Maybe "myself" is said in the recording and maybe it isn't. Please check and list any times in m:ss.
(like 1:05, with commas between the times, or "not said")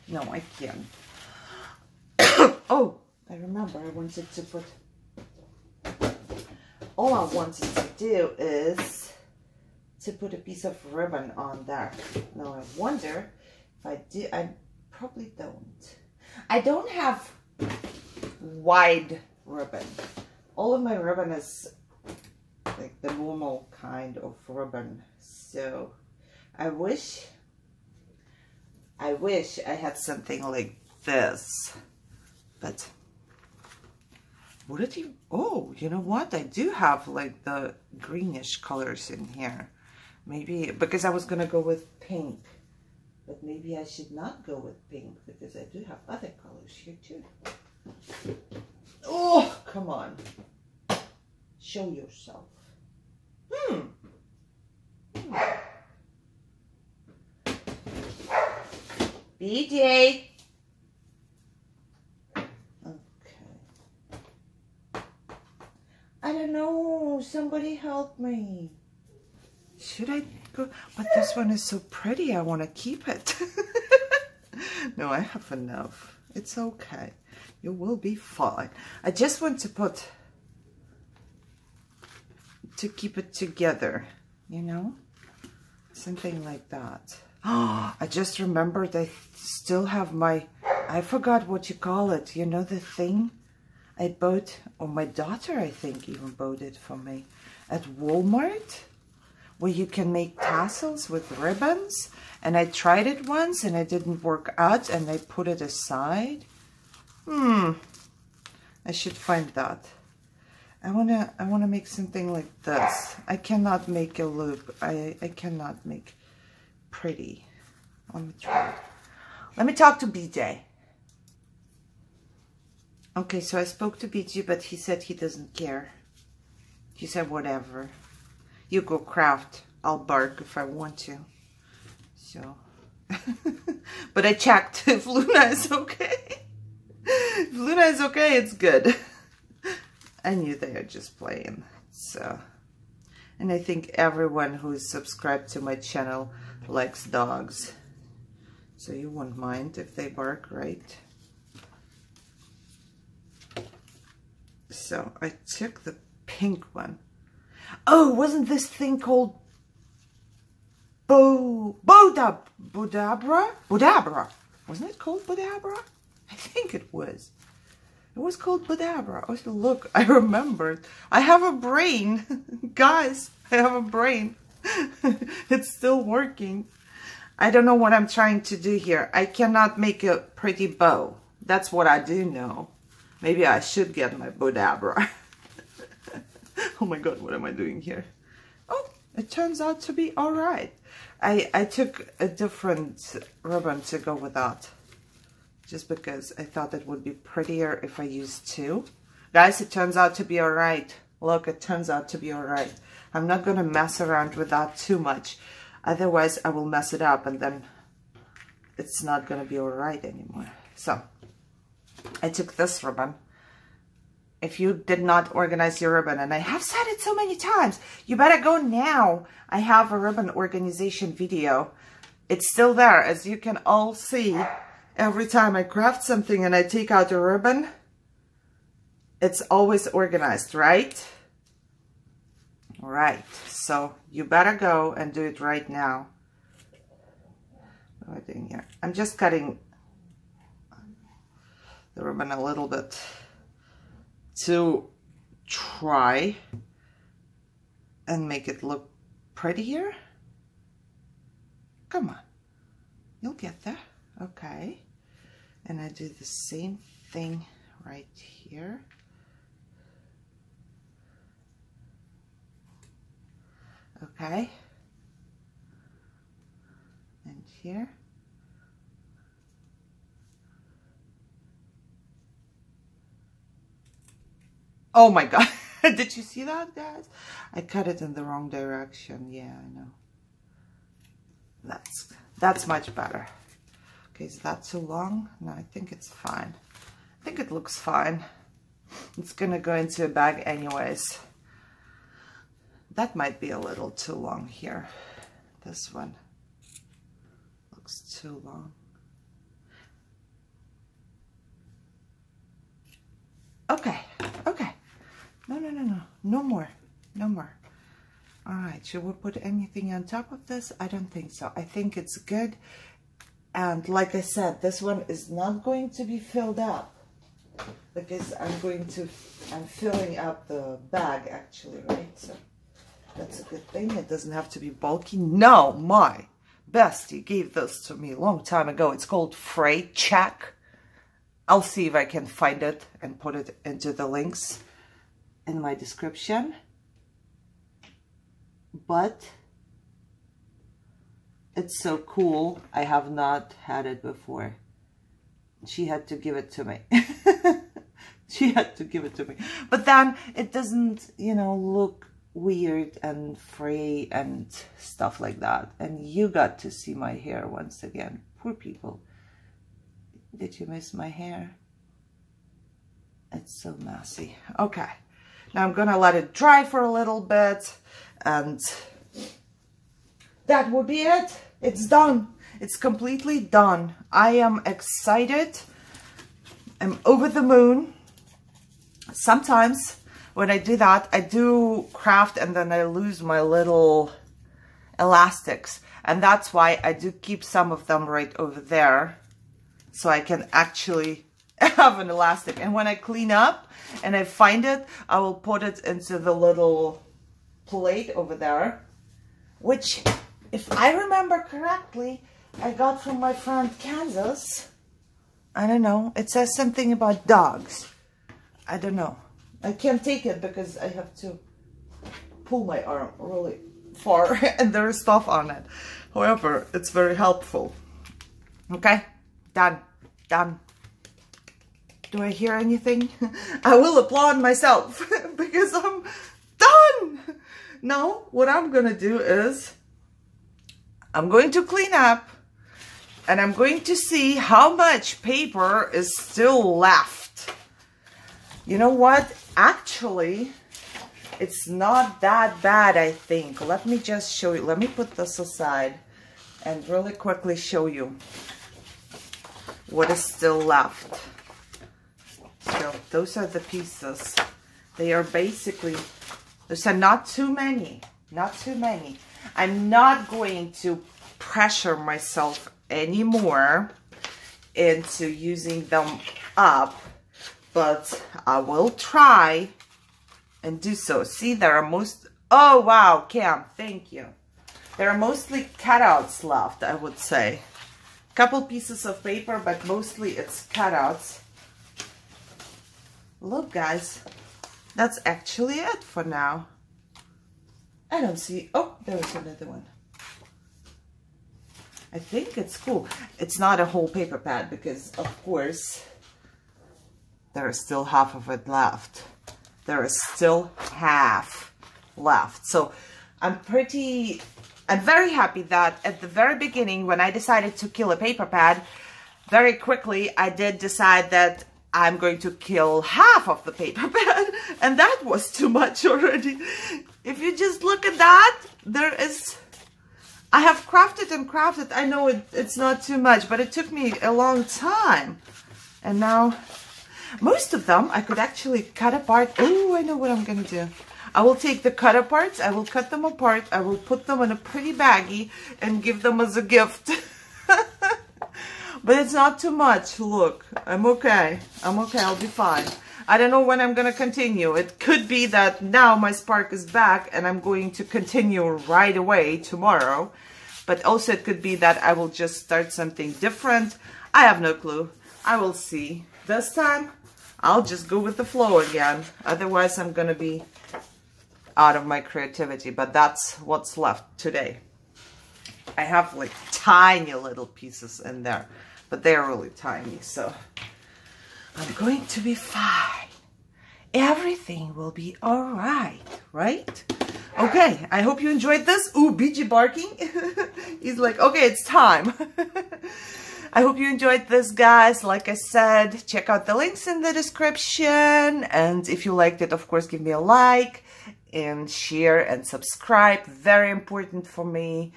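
7:04, 7:41.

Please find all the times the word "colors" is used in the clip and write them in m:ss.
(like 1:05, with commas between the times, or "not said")
0:38, 0:46.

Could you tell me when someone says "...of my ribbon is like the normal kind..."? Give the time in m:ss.
0:20.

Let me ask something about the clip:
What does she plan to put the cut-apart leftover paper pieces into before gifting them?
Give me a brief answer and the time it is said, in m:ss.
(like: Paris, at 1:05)
a pretty baggie, at 8:54.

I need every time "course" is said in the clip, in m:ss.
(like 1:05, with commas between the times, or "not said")
8:15, 9:49.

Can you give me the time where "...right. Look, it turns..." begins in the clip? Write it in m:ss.
3:20.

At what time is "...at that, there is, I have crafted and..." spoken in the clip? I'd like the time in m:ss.
8:38.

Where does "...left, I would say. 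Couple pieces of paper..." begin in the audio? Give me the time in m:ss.
7:56.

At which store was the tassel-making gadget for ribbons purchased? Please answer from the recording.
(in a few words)
Walmart.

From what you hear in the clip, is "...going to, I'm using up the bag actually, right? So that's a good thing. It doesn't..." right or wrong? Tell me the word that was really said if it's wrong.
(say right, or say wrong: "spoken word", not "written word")
wrong: "filling", not "using".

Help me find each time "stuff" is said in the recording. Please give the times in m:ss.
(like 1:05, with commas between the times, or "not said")
5:54, 6:55.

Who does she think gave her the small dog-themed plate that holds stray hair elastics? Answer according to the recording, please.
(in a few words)
Kansas.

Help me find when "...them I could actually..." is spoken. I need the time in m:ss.
8:47.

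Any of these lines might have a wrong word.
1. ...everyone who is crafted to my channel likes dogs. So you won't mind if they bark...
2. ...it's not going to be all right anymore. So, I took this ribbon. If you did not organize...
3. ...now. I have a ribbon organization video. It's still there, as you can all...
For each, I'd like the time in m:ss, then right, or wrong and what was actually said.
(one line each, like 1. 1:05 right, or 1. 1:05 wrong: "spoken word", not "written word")
1. 2:23 wrong: "subscribed", not "crafted"
2. 3:28 right
3. 3:38 right.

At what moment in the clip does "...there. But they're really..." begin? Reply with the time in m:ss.
9:28.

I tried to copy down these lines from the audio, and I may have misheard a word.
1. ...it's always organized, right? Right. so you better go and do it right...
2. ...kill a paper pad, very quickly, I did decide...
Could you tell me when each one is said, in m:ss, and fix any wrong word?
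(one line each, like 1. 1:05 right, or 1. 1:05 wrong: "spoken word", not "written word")
1. 3:49 right
2. 8:27 right.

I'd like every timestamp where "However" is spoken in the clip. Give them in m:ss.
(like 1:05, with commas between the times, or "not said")
6:56.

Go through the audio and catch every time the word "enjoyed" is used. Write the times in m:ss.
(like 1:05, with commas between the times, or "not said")
9:38, 9:44.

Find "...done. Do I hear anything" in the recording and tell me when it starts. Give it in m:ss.
7:00.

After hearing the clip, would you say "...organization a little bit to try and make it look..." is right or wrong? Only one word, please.
wrong.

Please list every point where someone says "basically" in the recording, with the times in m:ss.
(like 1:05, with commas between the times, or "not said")
7:35.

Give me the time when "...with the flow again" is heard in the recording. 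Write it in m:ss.
9:18.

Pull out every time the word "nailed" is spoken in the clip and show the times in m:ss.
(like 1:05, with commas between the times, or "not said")
not said.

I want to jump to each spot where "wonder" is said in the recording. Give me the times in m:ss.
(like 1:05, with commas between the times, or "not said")
0:12.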